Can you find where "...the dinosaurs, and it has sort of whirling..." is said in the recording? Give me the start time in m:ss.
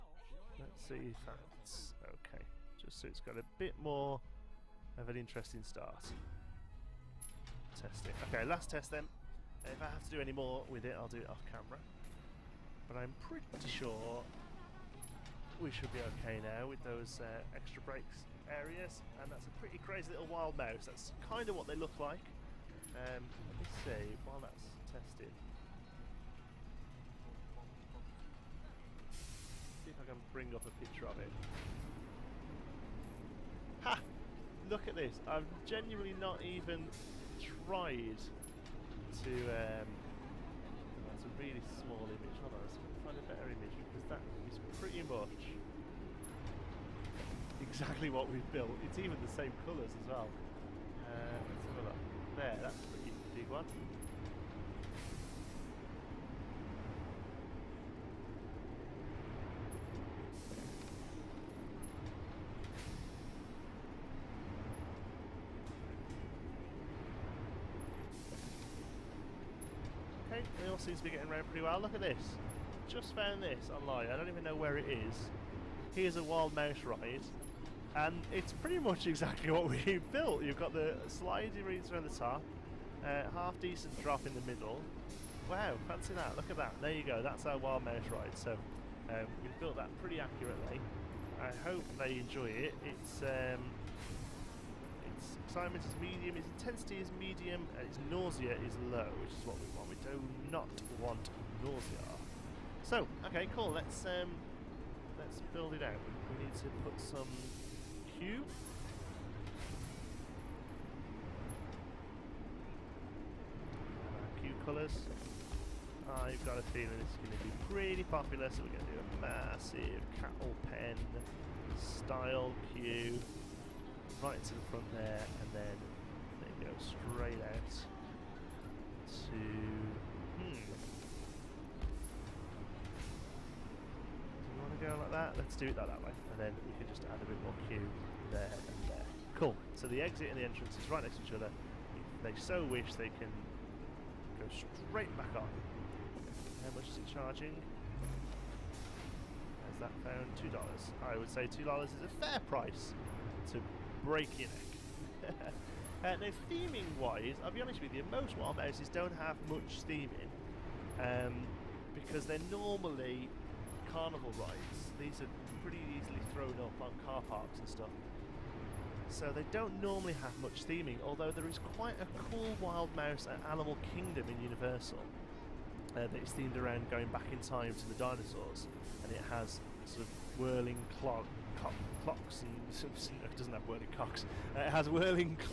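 2:57.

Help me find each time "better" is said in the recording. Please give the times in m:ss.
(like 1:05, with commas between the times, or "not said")
0:43.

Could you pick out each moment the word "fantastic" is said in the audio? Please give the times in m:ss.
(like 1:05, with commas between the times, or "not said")
not said.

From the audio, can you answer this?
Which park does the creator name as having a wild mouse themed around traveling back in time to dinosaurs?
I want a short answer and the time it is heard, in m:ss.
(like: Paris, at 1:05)
Animal Kingdom, at 2:53.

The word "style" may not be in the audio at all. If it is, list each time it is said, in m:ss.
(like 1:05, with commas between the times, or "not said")
2:01.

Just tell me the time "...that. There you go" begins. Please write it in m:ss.
1:26.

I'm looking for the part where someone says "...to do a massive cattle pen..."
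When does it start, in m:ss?
1:58.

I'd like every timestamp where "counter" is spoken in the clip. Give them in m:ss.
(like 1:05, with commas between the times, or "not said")
not said.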